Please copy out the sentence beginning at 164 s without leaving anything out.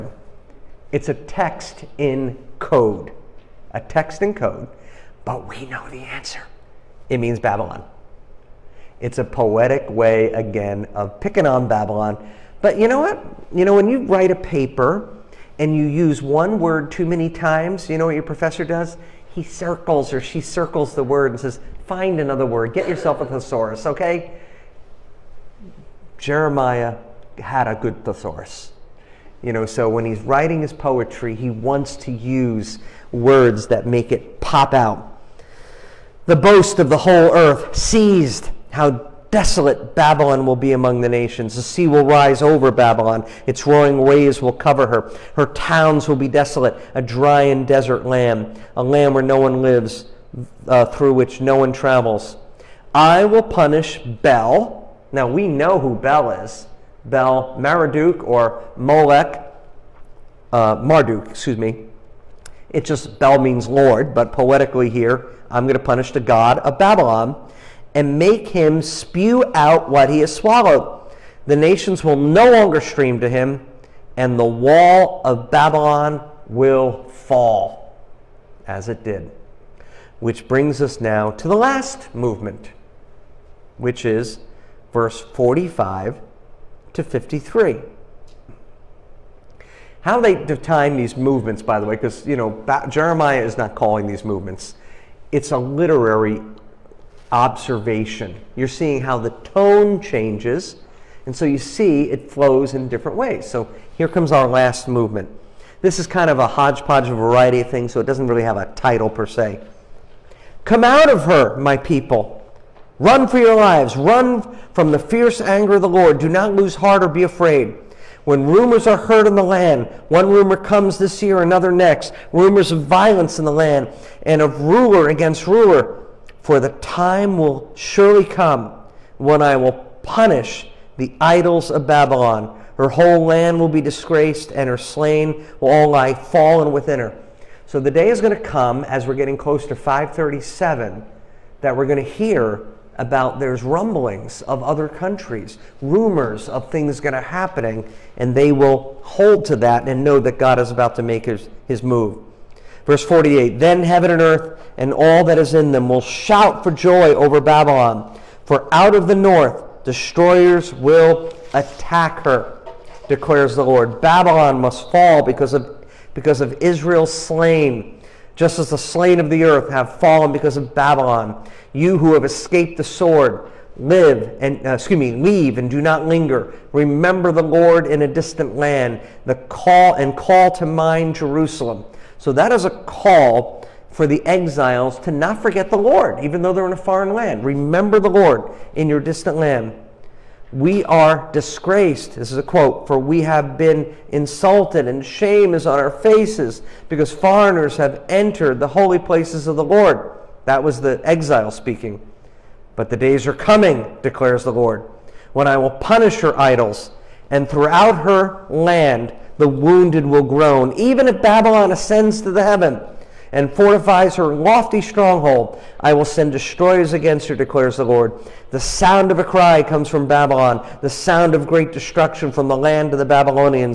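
Babylon must fall because of, because of Israel's slain just as the slain of the earth have fallen because of Babylon.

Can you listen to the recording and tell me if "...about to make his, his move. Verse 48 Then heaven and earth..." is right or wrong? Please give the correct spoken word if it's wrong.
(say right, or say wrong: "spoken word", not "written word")
right.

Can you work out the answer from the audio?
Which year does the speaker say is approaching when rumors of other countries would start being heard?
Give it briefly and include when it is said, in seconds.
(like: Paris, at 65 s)
537, at 139 s.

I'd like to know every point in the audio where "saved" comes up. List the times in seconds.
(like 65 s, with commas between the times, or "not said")
not said.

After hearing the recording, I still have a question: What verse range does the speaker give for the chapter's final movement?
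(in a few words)
45 to 53.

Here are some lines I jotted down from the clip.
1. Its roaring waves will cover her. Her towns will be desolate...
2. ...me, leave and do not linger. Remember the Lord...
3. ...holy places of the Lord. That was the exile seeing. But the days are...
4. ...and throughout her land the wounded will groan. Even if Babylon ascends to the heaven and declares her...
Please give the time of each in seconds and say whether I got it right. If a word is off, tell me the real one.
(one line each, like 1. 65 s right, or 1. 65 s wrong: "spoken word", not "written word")
1. 43 s right
2. 174 s right
3. 198 s wrong: "speaking", not "seeing"
4. 207 s wrong: "fortifies", not "declares".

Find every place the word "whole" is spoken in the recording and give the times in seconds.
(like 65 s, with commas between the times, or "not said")
36 s, 132 s.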